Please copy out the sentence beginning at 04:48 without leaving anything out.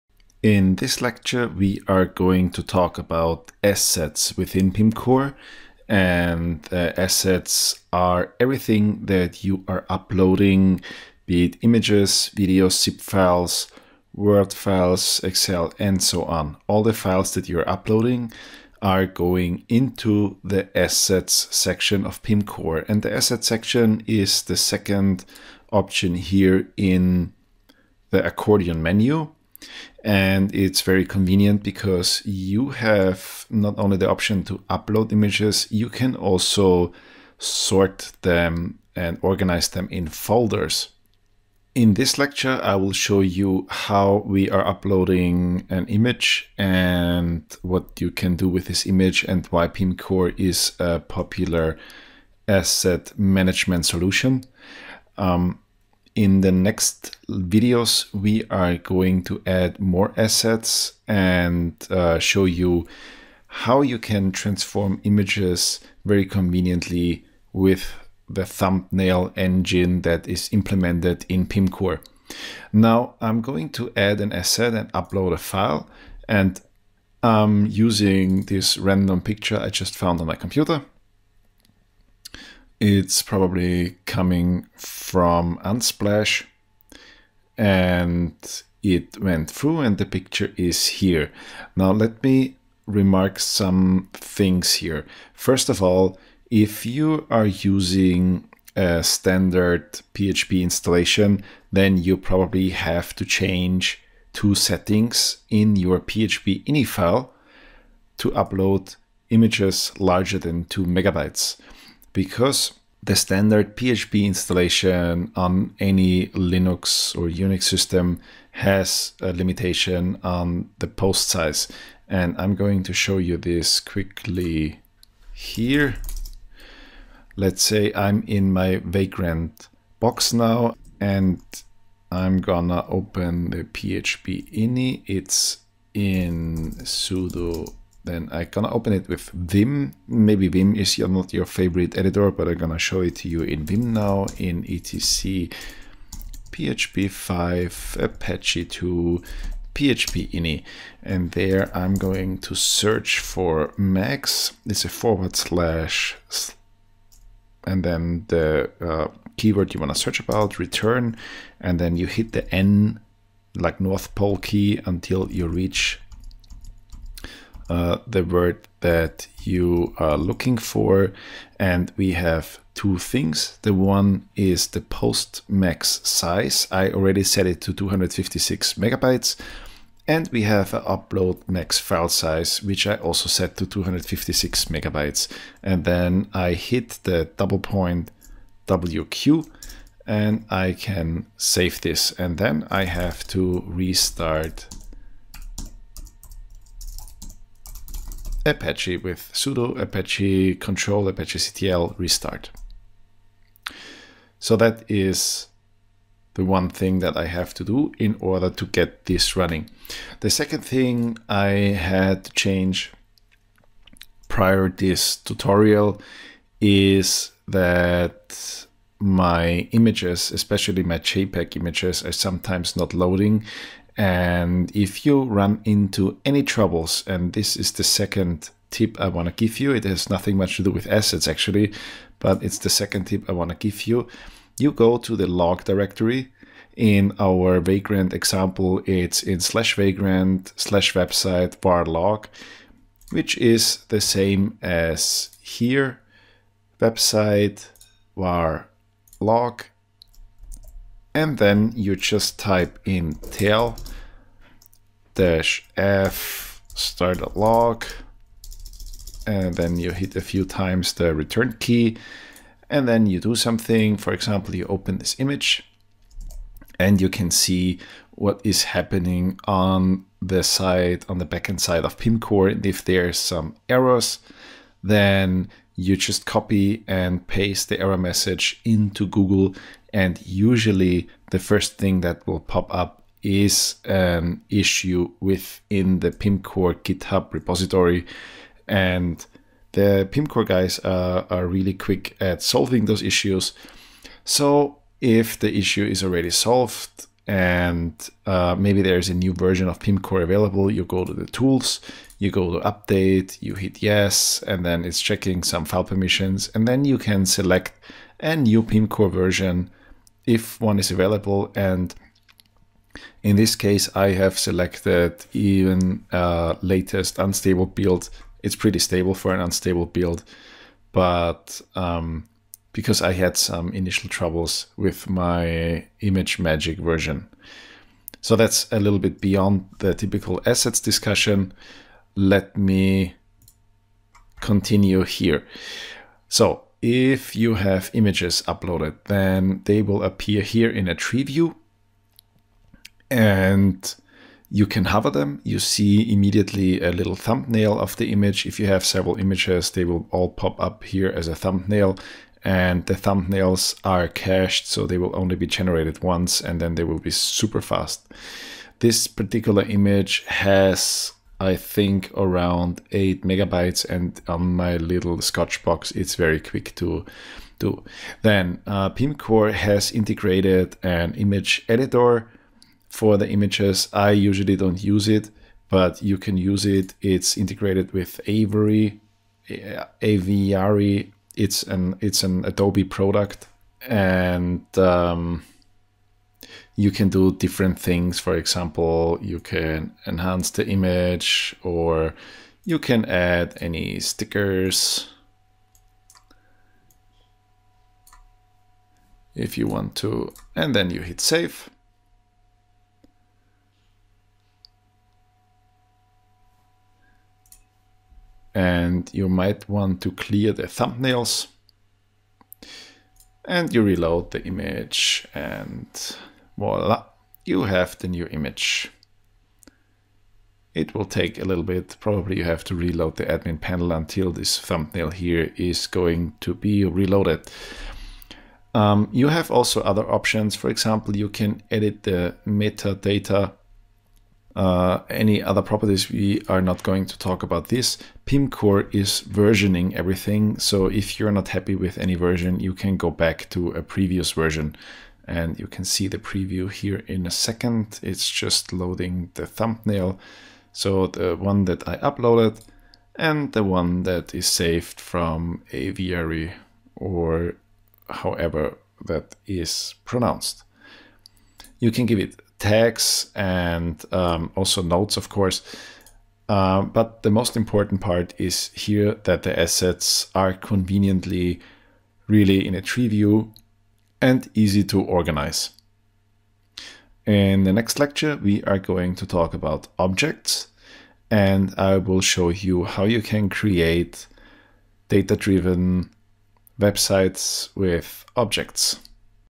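And the PIMCore guys are, are really quick at solving those issues.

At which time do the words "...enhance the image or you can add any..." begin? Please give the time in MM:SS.
06:30.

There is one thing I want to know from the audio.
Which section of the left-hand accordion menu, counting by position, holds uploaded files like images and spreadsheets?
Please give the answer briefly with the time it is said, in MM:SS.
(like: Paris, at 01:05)
second option, at 00:24.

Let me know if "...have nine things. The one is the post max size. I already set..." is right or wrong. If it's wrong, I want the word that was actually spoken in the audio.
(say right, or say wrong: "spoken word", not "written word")
wrong: "two", not "nine".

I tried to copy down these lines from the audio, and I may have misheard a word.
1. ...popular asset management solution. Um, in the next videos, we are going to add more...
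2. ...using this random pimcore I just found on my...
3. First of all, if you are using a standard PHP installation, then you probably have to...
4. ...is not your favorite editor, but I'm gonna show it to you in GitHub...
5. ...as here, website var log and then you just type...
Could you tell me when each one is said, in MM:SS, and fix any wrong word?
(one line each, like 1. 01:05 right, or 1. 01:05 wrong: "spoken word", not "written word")
1. 00:50 right
2. 01:17 wrong: "picture", not "pimcore"
3. 01:35 right
4. 02:20 wrong: "Vim", not "GitHub"
5. 04:04 right.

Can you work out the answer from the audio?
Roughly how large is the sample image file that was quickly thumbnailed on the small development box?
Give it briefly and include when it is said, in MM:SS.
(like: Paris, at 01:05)
8 megabytes, at 06:02.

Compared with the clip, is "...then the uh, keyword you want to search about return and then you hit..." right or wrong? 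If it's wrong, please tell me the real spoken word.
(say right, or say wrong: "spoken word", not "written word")
right.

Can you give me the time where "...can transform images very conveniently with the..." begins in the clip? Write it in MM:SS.
01:03.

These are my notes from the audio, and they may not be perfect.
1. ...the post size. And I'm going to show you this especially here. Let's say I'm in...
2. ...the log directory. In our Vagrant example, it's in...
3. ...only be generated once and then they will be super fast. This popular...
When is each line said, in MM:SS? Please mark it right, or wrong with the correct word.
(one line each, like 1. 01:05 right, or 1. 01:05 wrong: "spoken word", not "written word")
1. 02:00 wrong: "quickly", not "especially"
2. 03:55 right
3. 05:55 wrong: "particular", not "popular".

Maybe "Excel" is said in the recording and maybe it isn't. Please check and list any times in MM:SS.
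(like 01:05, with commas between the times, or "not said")
00:15.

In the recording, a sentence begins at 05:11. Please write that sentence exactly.
And in this case, I have selected even uh, latest unstable build.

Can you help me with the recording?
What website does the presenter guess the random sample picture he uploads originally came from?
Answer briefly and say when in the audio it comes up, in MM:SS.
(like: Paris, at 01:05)
Unsplash, at 01:25.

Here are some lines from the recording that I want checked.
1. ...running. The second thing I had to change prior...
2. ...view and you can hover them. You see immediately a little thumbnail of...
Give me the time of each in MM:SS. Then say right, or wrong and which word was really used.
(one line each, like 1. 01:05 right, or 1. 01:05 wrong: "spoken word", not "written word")
1. 03:29 right
2. 05:41 right.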